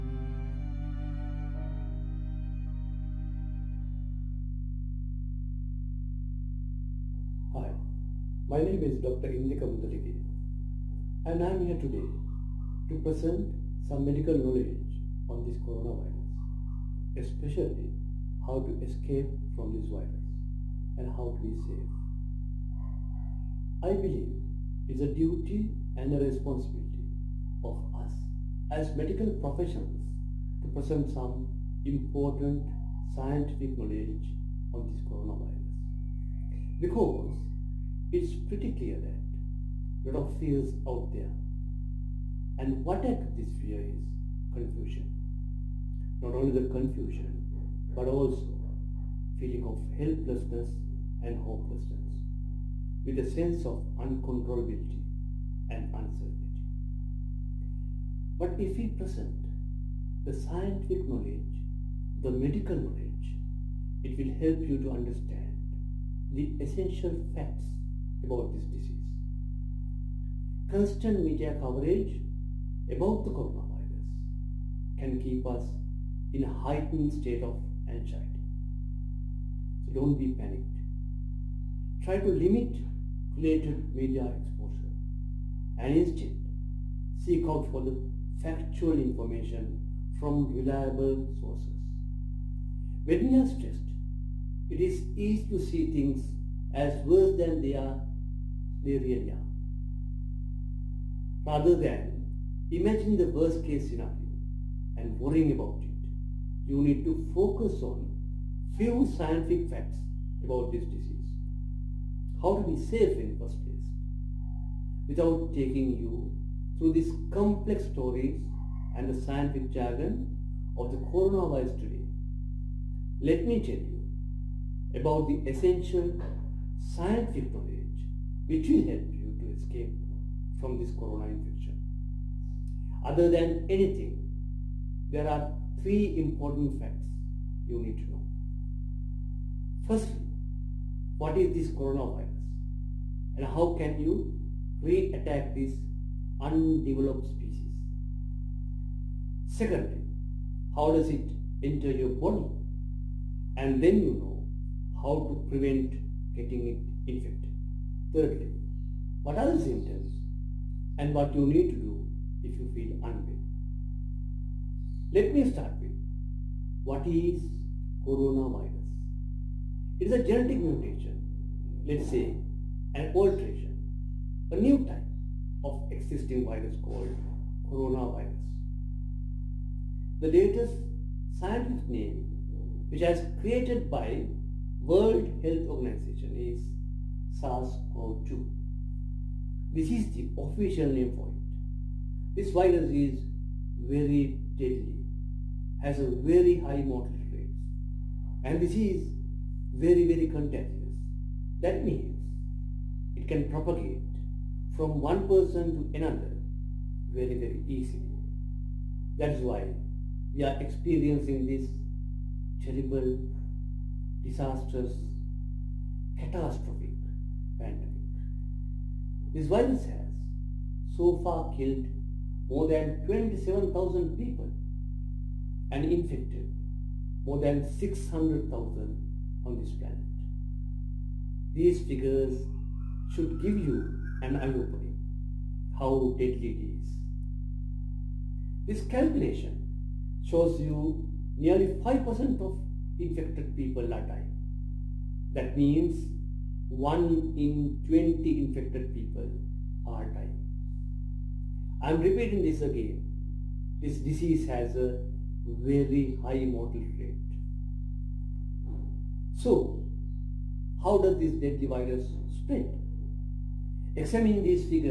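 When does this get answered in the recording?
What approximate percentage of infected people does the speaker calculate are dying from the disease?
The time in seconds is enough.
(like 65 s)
241 s.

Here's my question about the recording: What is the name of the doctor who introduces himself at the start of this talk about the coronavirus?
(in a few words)
Indika Mudalige.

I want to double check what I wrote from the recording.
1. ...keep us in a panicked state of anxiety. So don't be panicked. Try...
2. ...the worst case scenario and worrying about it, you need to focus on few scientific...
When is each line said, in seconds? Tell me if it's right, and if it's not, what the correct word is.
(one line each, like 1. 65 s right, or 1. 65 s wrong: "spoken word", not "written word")
1. 75 s wrong: "heightened", not "panicked"
2. 103 s right.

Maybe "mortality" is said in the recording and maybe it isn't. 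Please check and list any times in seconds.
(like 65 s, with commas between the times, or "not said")
196 s, 256 s.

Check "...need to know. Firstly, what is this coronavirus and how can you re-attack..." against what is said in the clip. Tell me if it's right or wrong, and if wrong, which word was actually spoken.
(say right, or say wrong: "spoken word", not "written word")
right.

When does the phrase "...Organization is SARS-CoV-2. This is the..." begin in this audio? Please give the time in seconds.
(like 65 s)
185 s.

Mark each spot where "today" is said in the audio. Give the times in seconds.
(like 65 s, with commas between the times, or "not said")
11 s, 121 s.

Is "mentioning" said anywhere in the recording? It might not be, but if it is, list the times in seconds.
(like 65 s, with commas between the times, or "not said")
not said.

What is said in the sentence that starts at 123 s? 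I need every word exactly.
Let me tell you about the essential scientific knowledge which will help you to escape from this corona infection.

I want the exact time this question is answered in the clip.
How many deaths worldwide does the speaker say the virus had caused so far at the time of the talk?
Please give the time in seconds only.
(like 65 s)
222 s.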